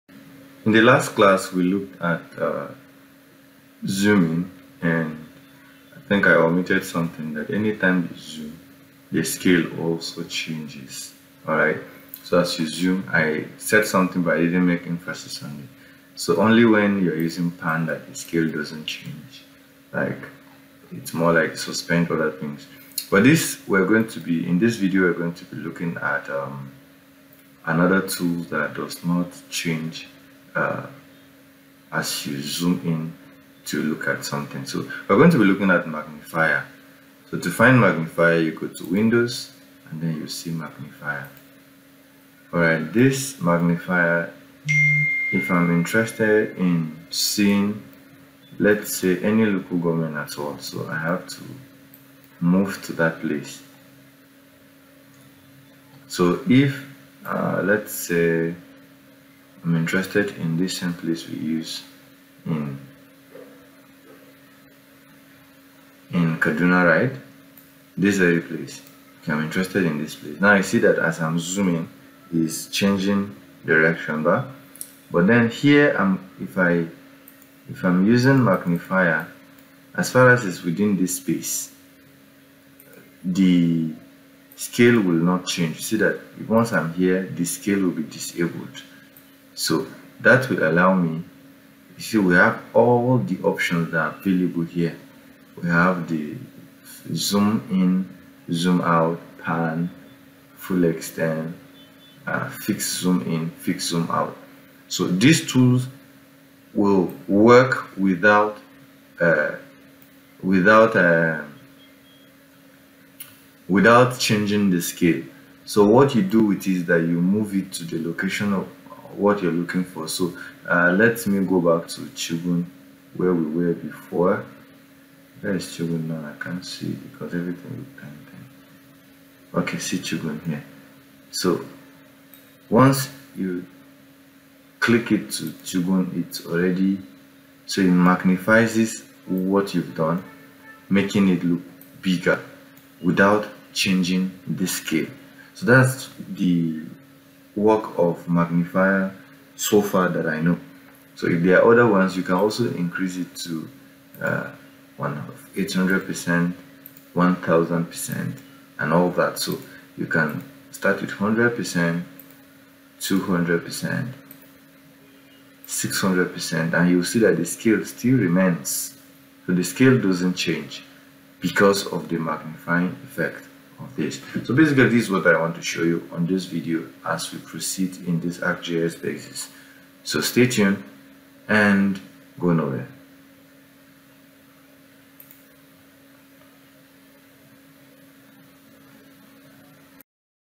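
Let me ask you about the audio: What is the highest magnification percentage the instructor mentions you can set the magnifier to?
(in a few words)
1000%.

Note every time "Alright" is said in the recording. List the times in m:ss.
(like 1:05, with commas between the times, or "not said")
0:11, 0:42.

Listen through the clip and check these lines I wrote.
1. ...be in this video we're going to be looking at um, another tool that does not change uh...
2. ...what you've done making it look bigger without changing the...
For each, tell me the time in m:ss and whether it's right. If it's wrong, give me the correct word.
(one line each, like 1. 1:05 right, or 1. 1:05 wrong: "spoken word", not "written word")
1. 0:24 right
2. 2:19 right.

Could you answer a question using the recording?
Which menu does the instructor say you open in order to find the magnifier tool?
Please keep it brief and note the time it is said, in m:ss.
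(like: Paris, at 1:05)
Windows, at 0:38.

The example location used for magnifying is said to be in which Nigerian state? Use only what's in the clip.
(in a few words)
Kaduna.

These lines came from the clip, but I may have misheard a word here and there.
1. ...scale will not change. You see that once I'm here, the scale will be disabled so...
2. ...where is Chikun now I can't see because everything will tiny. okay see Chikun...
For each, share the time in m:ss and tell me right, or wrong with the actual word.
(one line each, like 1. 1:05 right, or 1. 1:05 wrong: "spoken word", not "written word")
1. 1:24 right
2. 2:05 right.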